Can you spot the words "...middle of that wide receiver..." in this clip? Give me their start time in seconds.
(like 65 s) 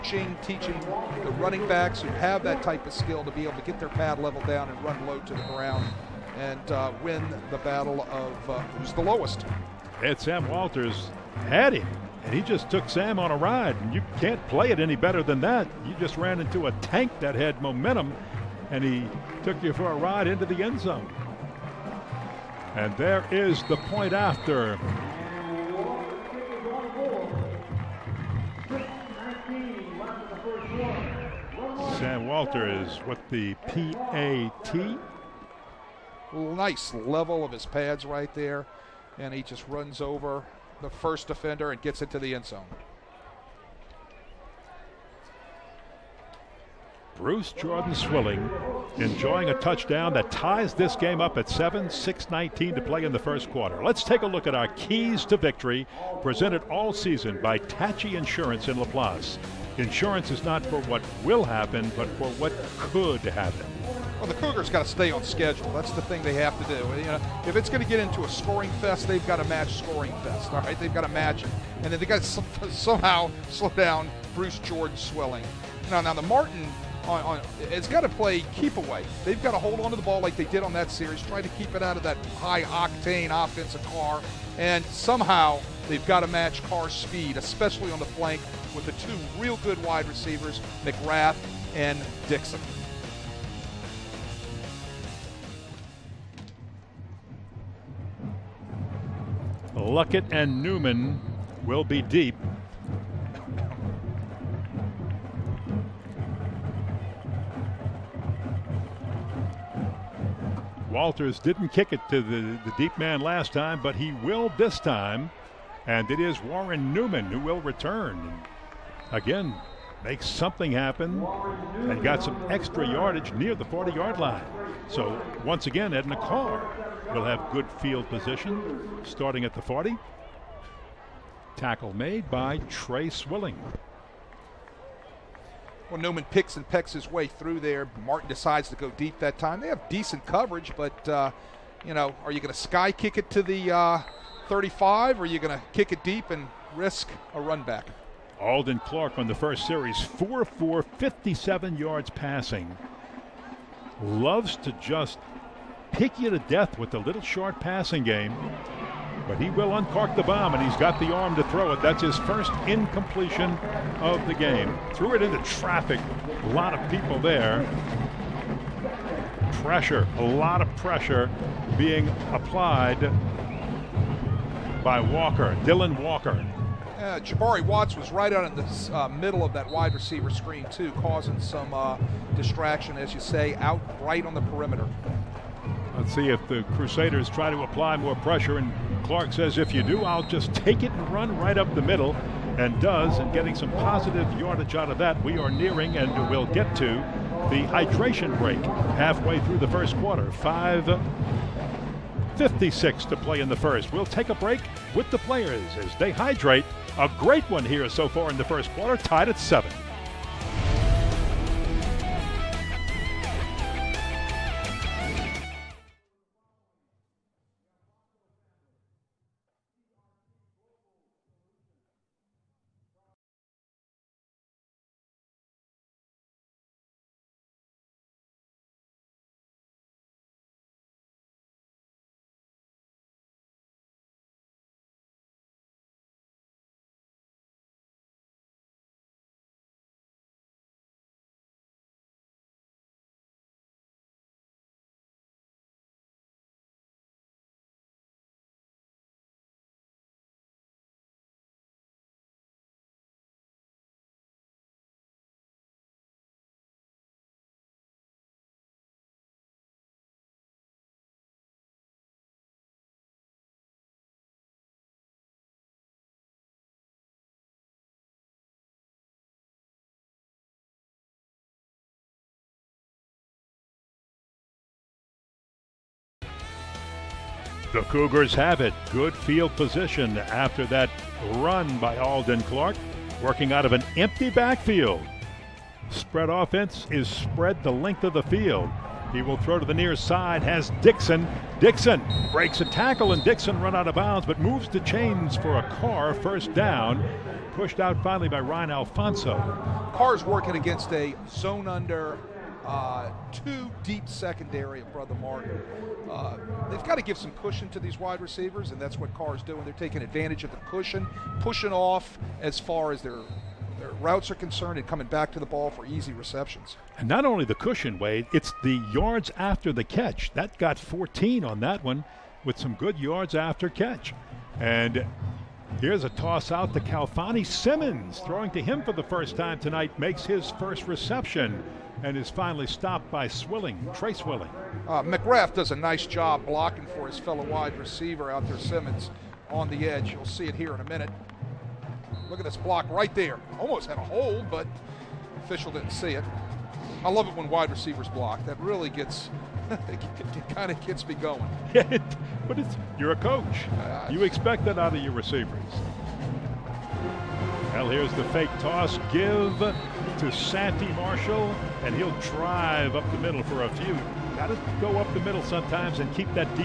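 179 s.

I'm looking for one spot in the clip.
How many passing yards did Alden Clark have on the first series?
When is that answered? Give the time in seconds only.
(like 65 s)
150 s.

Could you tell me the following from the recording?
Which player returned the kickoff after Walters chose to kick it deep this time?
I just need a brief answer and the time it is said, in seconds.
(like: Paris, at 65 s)
Warren Newman, at 116 s.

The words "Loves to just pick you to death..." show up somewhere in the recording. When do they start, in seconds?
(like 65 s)
154 s.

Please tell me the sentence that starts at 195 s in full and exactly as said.
We are nearing and we'll get to the hydration break halfway through the first quarter.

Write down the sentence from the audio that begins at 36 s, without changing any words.
Nice level of his pads right there.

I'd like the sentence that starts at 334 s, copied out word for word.
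Uh, does a nice job blocking for his fellow wide receiver out there, Simmons, on the edge.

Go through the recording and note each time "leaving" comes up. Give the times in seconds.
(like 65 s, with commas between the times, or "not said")
not said.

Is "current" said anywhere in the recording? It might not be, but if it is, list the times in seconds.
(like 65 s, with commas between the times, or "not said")
not said.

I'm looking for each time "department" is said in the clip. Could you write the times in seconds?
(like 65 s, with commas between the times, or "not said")
not said.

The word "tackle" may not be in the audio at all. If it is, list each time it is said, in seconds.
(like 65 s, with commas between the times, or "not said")
131 s, 292 s.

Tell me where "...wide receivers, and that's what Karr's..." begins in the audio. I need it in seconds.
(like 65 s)
307 s.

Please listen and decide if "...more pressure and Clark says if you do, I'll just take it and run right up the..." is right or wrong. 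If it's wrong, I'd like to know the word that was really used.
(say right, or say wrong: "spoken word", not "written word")
right.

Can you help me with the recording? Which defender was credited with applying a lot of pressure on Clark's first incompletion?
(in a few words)
Dylan Walker.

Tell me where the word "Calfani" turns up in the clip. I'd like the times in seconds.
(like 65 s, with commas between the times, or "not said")
326 s.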